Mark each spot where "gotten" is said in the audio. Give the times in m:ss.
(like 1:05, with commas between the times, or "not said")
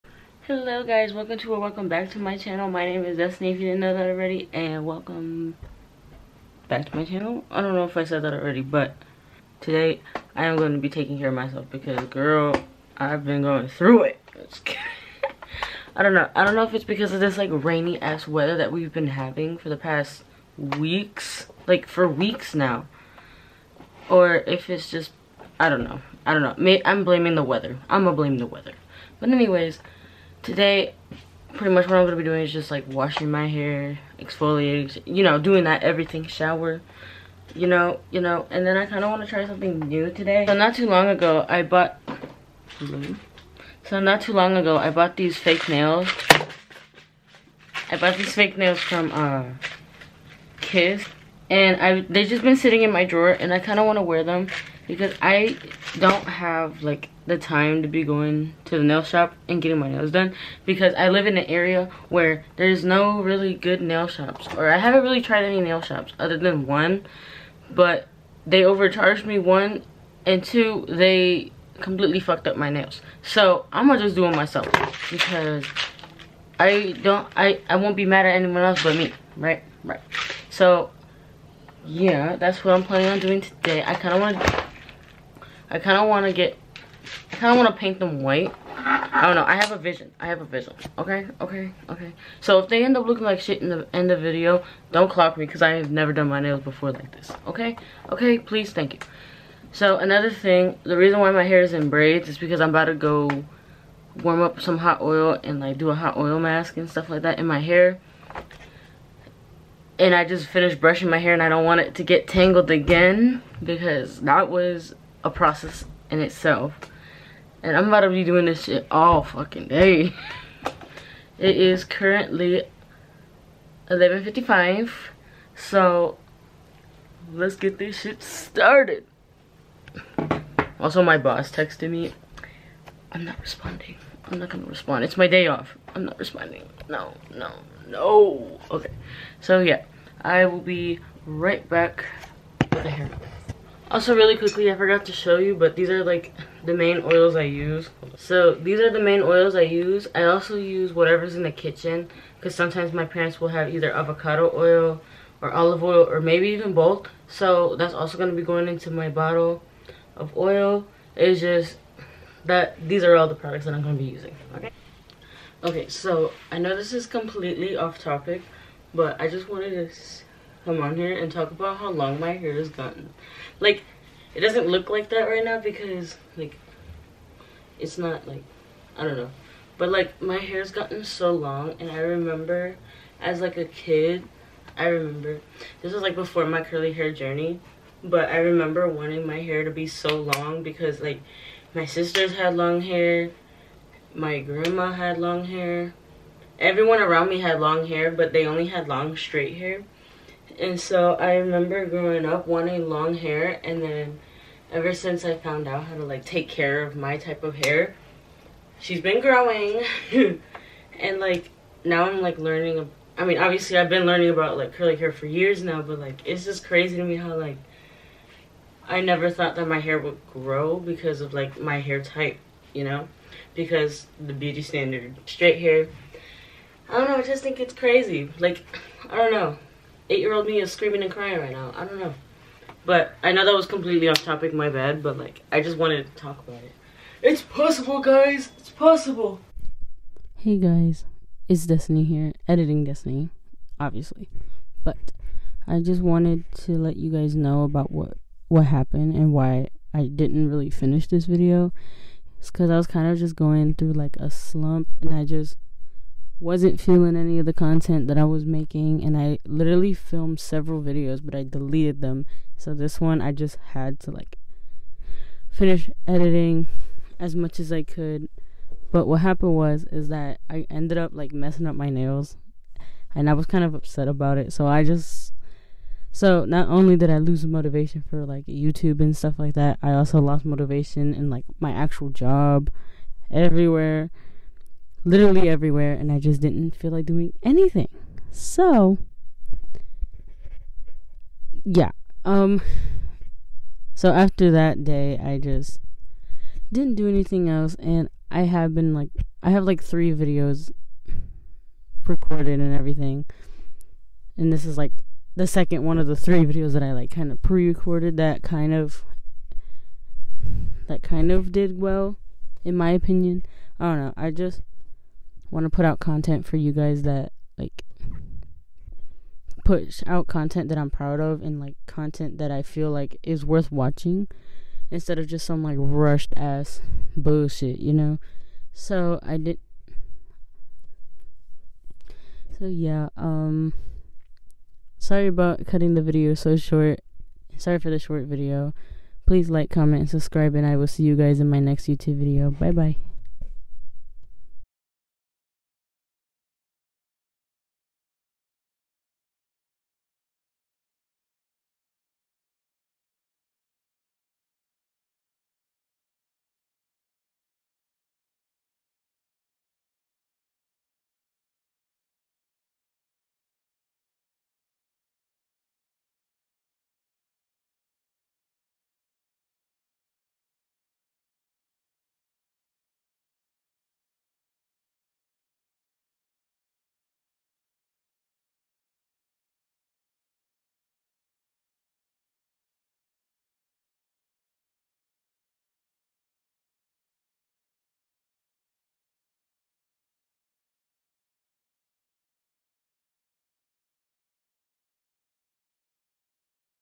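2:52, 3:00.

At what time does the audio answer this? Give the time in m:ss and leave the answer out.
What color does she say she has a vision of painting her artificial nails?
1:28.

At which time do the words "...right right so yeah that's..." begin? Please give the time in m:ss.
1:19.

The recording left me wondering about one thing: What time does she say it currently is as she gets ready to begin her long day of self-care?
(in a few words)
11.55.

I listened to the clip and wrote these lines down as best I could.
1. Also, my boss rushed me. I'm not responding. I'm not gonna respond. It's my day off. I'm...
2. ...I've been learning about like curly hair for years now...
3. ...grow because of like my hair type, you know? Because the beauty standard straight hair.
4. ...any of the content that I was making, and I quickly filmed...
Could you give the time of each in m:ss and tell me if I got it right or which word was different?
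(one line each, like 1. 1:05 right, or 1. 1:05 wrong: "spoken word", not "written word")
1. 2:10 wrong: "texted", not "rushed"
2. 3:33 right
3. 3:40 right
4. 4:17 wrong: "literally", not "quickly".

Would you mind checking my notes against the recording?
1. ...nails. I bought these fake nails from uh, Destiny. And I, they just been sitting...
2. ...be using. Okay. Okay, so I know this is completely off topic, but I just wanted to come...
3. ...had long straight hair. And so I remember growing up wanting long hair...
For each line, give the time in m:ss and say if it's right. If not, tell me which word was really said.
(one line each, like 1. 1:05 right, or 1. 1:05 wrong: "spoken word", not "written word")
1. 0:45 wrong: "Kiss", not "Destiny"
2. 2:44 right
3. 3:18 right.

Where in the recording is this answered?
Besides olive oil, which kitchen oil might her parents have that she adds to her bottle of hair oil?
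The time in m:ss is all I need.
2:33.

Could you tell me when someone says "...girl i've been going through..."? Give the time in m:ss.
0:12.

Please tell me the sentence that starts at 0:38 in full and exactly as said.
And then I kind of want to try something new today.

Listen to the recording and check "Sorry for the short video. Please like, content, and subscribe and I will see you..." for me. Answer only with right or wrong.
wrong.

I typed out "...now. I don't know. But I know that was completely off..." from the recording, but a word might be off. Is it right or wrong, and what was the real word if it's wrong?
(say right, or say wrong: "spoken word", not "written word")
right.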